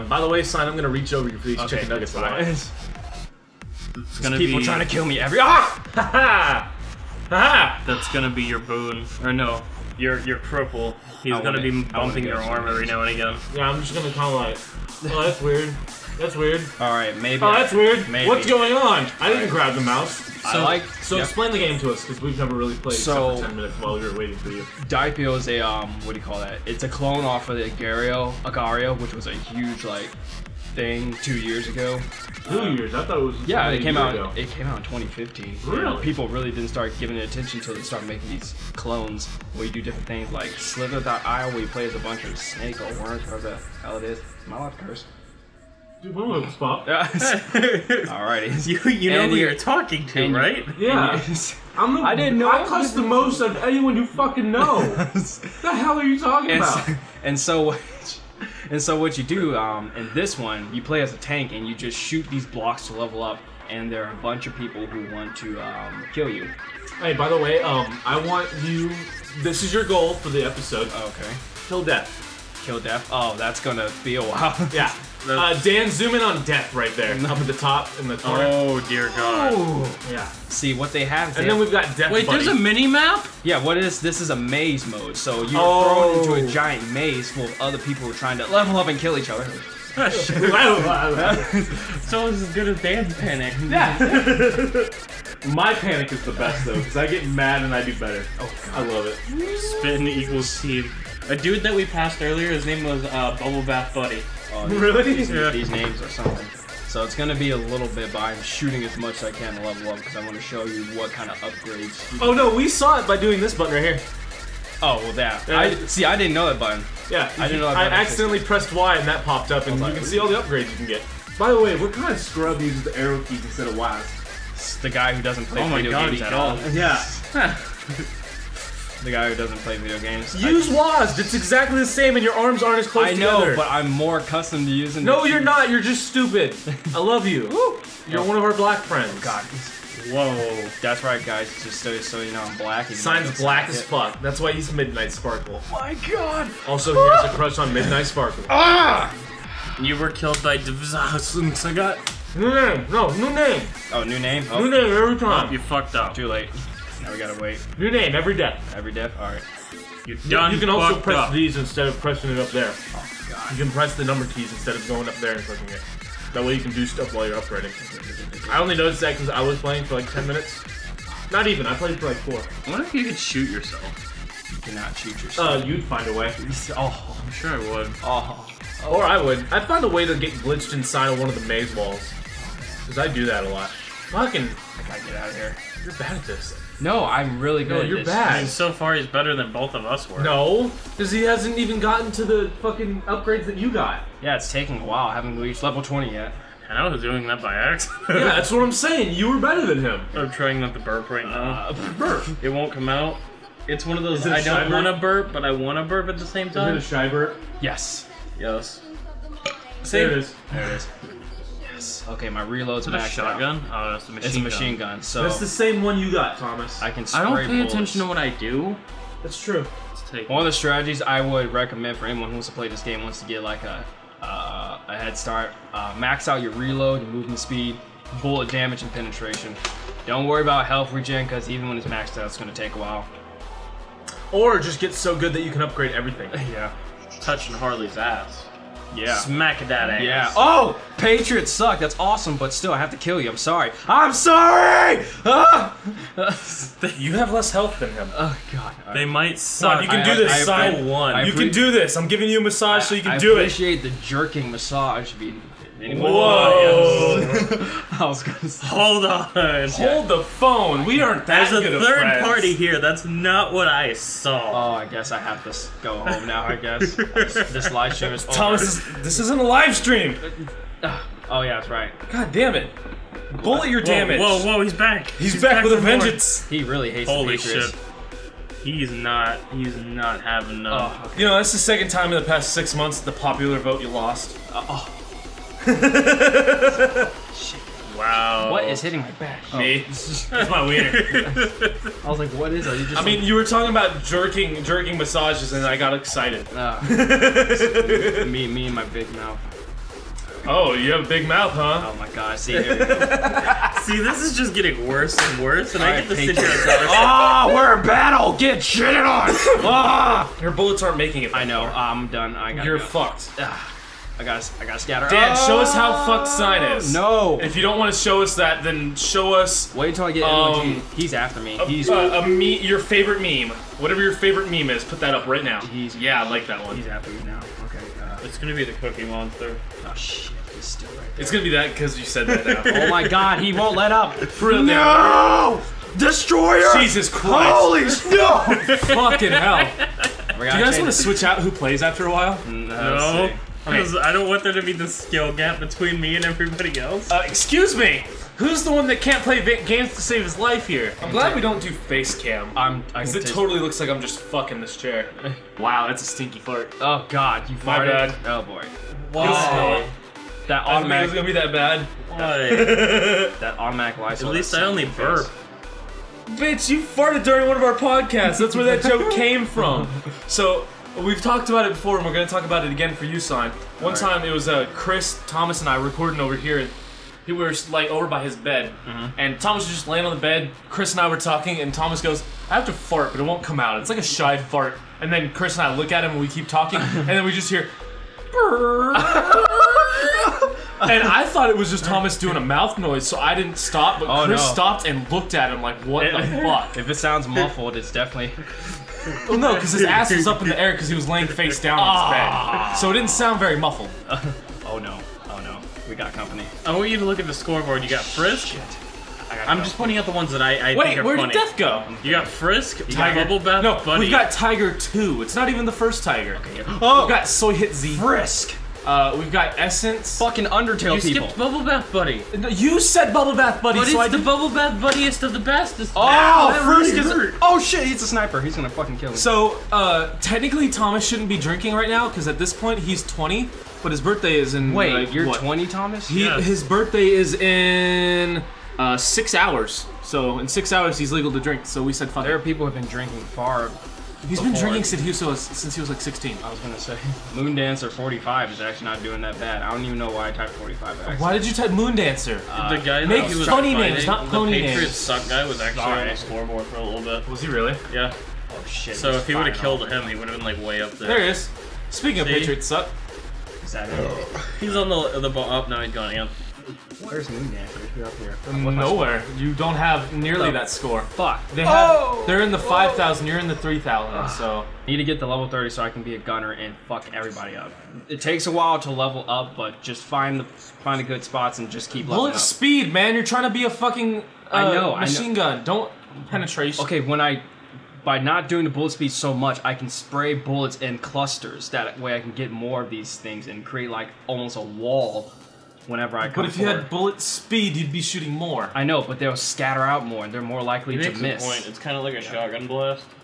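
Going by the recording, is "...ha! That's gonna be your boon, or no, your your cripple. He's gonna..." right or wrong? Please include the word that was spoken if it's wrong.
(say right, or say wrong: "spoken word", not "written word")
right.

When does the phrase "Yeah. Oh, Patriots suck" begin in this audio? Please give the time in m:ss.
4:00.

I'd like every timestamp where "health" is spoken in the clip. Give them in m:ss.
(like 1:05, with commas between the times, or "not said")
3:50, 4:07.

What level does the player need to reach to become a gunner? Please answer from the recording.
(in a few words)
30.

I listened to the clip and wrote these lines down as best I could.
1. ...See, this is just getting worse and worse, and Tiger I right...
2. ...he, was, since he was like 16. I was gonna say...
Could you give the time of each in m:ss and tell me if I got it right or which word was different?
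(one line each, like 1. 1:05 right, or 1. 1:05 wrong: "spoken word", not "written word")
1. 5:02 wrong: "All", not "Tiger"
2. 7:25 right.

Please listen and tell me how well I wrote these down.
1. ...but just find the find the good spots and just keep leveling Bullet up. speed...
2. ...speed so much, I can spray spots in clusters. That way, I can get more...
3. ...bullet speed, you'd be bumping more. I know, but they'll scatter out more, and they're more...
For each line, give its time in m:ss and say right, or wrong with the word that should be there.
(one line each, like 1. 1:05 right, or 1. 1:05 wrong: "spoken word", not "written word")
1. 7:59 right
2. 8:08 wrong: "bullets", not "spots"
3. 8:16 wrong: "shooting", not "bumping".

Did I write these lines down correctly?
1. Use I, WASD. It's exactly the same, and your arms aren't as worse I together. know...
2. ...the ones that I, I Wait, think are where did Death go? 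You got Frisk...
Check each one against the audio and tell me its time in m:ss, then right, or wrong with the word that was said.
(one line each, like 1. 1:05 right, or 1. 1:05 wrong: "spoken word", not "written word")
1. 2:10 wrong: "close", not "worse"
2. 6:50 right.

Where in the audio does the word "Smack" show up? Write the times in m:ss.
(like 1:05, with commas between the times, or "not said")
3:59.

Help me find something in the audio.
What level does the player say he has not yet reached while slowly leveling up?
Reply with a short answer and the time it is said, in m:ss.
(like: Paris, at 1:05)
20, at 3:15.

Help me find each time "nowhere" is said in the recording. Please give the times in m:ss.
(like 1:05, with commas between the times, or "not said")
7:48.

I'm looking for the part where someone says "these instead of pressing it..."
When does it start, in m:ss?
2:41.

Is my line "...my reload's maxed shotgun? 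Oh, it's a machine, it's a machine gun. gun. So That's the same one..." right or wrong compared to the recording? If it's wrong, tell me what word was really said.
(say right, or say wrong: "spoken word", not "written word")
right.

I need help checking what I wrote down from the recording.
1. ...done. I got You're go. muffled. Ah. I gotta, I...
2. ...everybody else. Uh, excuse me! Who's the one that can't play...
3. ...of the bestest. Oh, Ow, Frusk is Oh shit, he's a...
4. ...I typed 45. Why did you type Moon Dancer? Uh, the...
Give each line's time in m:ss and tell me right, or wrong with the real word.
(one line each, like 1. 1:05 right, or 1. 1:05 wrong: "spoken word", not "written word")
1. 5:12 wrong: "fucked", not "muffled"
2. 5:46 right
3. 7:05 right
4. 7:30 right.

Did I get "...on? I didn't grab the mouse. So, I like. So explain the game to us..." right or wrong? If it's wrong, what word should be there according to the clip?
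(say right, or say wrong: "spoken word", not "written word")
right.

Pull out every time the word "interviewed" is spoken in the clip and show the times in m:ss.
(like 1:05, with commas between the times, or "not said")
not said.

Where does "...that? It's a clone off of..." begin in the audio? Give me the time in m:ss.
0:26.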